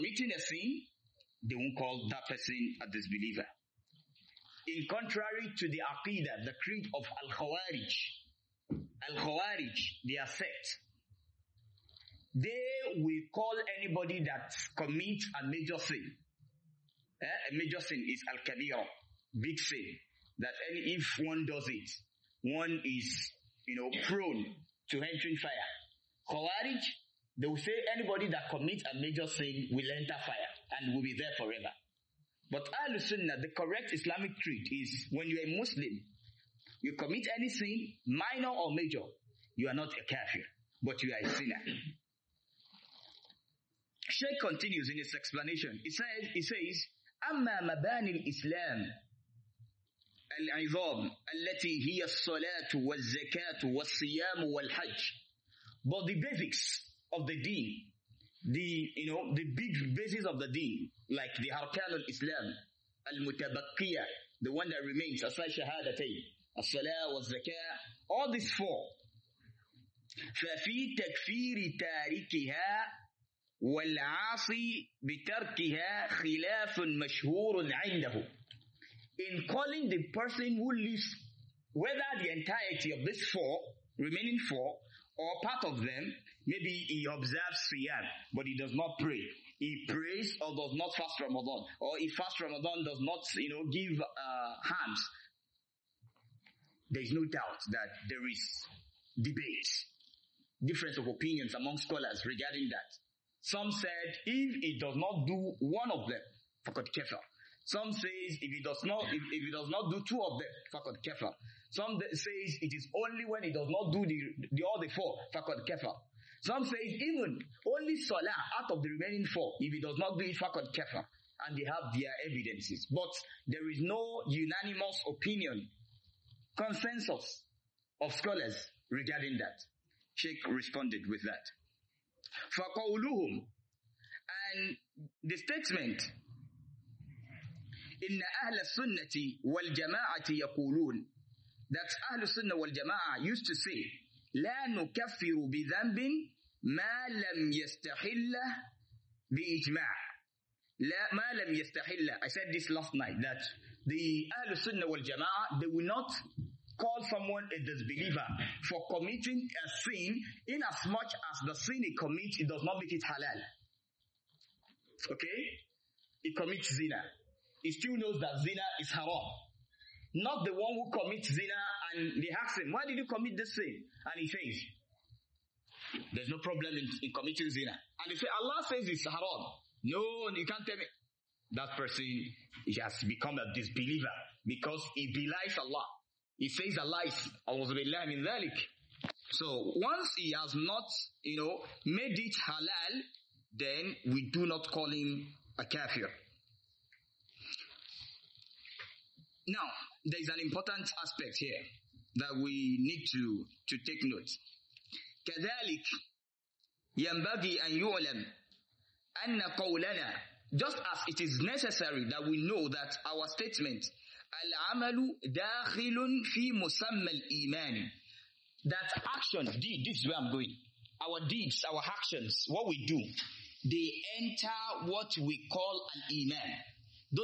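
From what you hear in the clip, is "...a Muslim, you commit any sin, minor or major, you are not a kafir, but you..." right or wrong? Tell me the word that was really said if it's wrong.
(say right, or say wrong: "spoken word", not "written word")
right.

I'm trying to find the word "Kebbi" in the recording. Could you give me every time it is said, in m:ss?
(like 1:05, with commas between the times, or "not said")
not said.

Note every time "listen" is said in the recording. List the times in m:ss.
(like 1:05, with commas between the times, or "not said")
0:32.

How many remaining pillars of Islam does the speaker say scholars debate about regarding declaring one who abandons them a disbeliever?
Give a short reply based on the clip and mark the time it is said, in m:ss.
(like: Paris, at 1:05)
4, at 1:08.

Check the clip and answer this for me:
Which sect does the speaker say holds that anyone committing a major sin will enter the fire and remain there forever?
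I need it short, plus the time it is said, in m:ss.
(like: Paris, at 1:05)
Al-Khawarij, at 0:06.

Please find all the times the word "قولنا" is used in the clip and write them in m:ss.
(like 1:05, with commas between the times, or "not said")
3:29.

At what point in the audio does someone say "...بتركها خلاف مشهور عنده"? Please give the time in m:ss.
1:15.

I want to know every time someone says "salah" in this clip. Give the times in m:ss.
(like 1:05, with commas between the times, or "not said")
1:06, 1:57.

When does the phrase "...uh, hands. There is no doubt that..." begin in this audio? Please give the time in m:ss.
1:34.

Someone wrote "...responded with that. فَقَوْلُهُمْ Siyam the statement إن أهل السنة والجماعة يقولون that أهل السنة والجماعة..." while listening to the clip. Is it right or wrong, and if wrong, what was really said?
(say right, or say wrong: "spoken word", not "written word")
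wrong: "And", not "Siyam".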